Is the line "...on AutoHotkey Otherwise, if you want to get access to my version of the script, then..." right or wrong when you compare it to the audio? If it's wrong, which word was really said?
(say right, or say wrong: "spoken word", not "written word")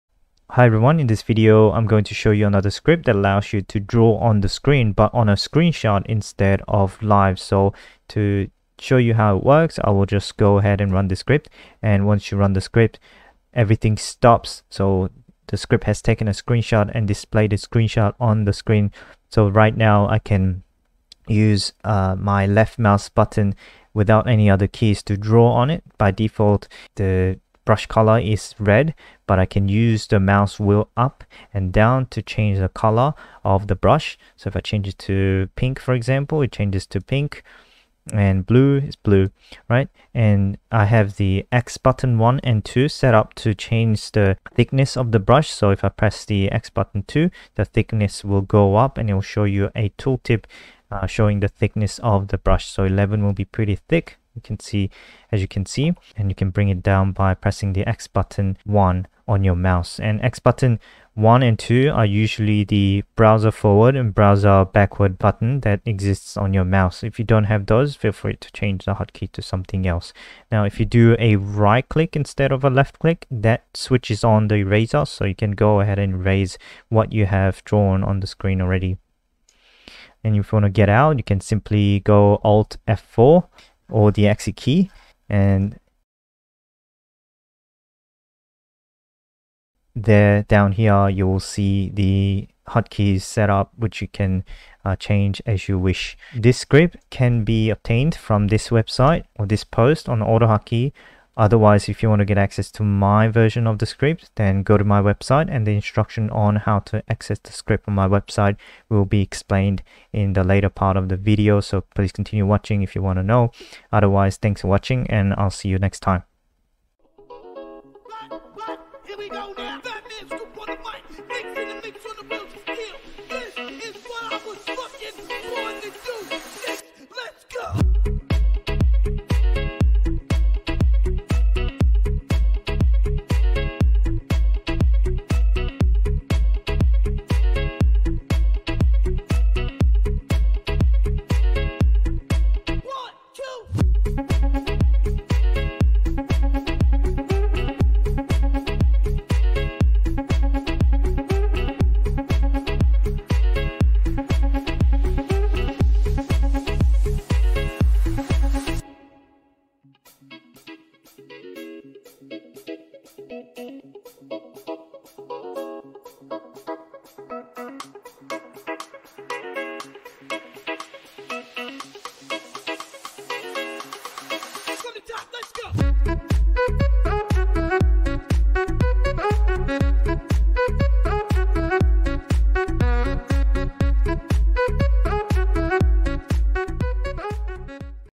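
right.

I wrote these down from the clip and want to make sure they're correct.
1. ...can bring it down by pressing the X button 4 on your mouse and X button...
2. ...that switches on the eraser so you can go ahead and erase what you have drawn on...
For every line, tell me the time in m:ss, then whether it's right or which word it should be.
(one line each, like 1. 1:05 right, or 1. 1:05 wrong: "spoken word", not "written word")
1. 0:56 wrong: "1", not "4"
2. 1:13 right.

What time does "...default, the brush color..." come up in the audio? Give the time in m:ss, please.
0:26.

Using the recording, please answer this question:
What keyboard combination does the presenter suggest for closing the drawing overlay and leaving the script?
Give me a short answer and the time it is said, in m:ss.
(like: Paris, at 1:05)
Alt F4, at 1:22.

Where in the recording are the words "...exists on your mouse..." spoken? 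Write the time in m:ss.
1:05.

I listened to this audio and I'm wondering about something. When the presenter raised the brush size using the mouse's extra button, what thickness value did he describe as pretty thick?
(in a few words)
11.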